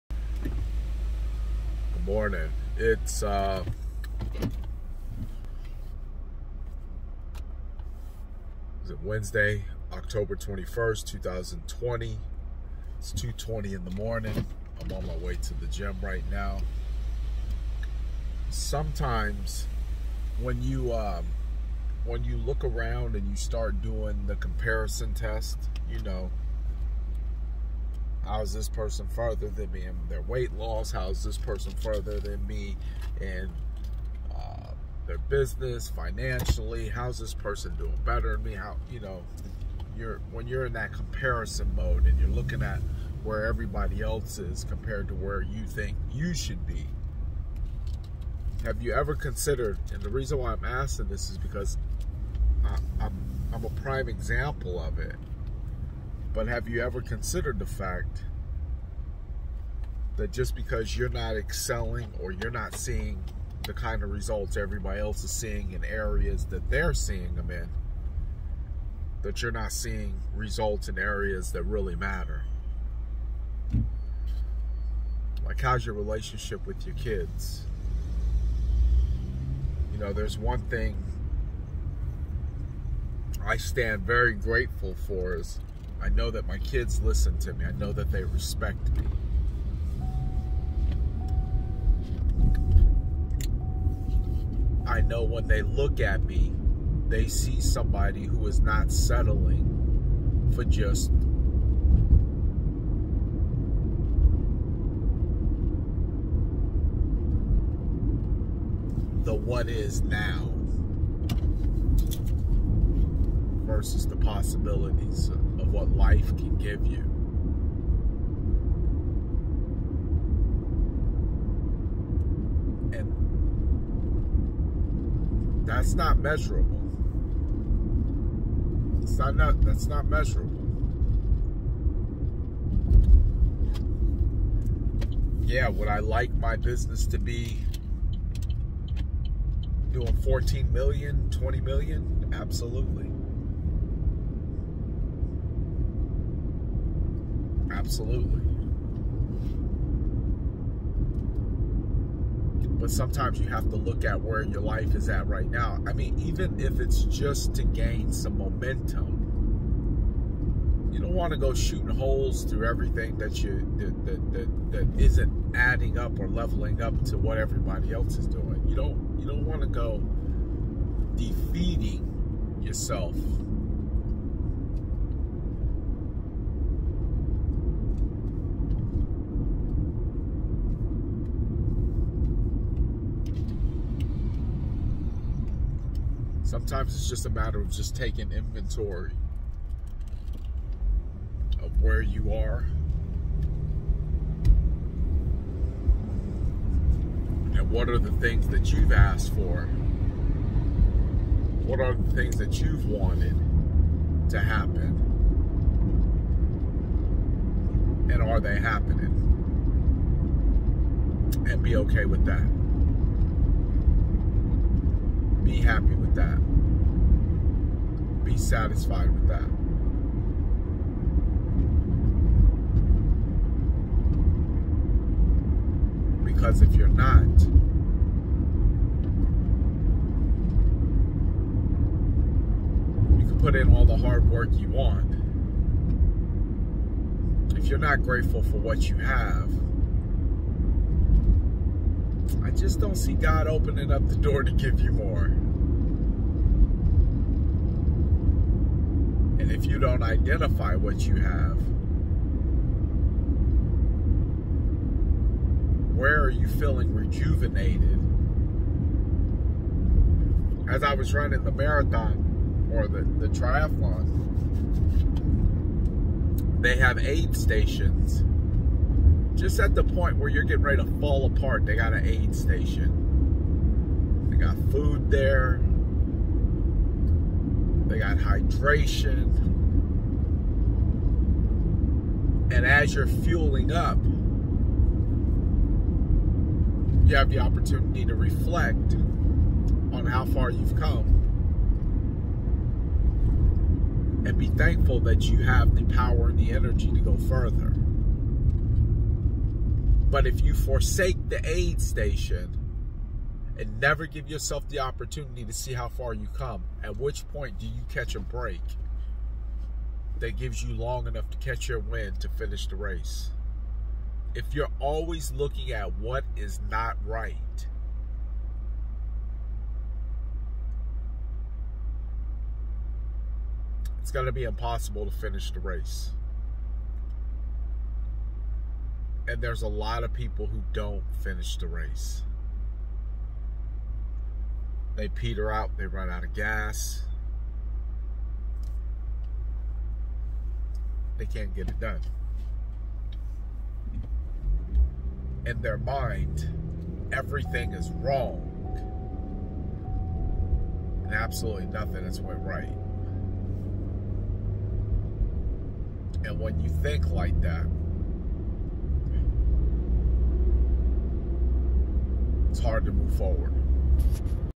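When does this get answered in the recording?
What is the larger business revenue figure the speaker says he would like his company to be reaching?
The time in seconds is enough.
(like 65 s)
141 s.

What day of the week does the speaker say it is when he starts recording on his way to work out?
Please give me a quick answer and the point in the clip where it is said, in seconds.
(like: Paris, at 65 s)
Wednesday, at 9 s.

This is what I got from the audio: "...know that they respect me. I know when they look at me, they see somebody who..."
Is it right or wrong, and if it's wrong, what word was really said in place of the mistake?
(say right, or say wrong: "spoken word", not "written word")
right.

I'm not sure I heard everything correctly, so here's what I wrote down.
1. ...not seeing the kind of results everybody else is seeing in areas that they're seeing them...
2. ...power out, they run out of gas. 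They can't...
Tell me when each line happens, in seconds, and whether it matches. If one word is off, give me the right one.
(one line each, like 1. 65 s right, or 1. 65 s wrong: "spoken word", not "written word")
1. 62 s right
2. 335 s wrong: "peter", not "power".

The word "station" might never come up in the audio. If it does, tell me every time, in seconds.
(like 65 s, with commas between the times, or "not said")
267 s, 272 s, 301 s.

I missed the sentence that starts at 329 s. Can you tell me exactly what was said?
And there's a lot of people who don't finish the race.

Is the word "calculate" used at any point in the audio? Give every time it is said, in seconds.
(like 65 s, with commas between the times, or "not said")
not said.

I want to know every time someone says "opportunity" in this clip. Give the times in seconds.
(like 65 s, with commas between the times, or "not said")
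287 s, 304 s.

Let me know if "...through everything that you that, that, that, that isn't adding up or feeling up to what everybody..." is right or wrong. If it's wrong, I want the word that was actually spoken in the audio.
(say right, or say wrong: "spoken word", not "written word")
wrong: "leveling", not "feeling".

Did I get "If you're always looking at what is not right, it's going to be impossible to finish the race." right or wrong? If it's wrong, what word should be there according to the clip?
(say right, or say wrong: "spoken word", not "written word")
right.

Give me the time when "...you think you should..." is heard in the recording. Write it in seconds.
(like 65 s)
45 s.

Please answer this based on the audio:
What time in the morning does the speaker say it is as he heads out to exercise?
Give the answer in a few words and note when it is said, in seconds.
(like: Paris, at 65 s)
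2:20, at 13 s.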